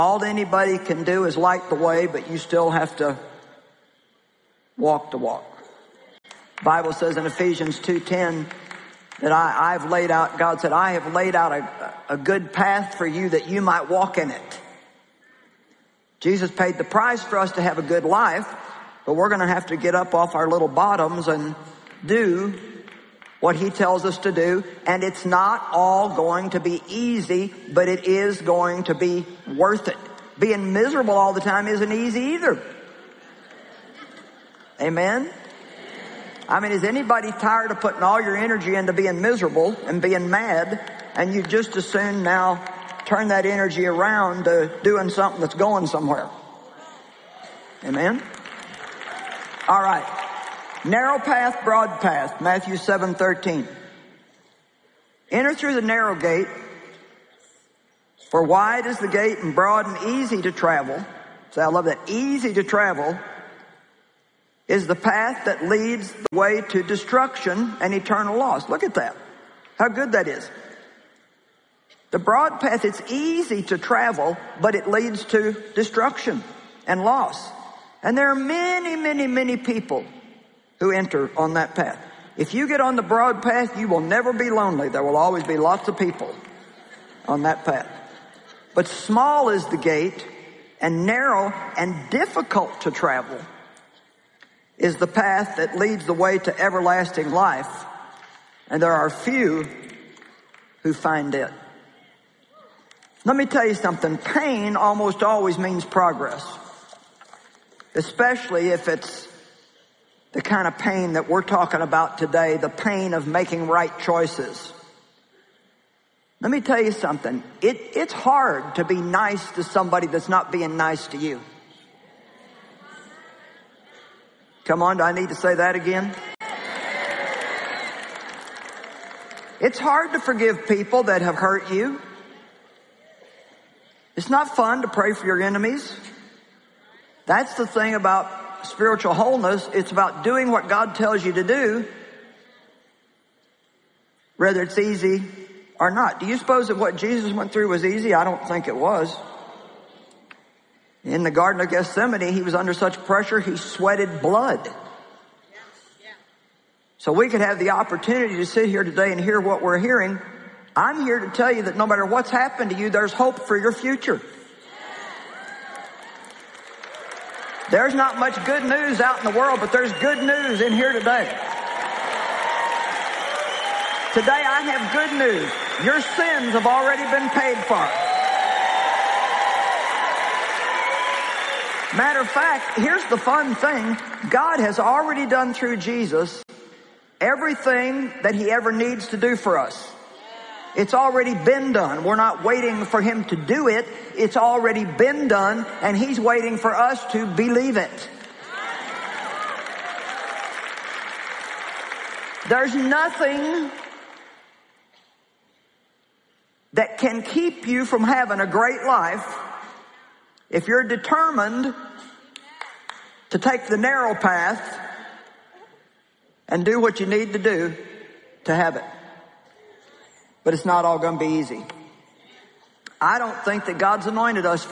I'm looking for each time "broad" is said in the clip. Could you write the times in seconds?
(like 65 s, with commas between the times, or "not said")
51 s, 59 s, 72 s, 83 s.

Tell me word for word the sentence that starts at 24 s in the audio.
And it's not all going to be easy, but it is going to be worth it.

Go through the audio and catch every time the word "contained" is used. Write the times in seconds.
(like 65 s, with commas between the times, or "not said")
not said.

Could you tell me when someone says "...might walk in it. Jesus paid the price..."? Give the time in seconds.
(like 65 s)
13 s.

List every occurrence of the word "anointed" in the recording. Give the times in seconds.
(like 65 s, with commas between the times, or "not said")
224 s.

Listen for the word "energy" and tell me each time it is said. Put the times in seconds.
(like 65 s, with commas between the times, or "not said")
38 s, 43 s.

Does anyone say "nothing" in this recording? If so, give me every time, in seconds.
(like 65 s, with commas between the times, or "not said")
202 s.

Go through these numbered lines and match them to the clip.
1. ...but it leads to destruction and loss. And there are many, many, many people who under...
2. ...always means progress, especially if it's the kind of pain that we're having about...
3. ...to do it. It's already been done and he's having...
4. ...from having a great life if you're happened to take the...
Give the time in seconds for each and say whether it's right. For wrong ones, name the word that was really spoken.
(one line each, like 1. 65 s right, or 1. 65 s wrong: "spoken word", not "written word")
1. 74 s wrong: "enter", not "under"
2. 105 s wrong: "talking", not "having"
3. 193 s wrong: "waiting", not "having"
4. 207 s wrong: "determined", not "happened".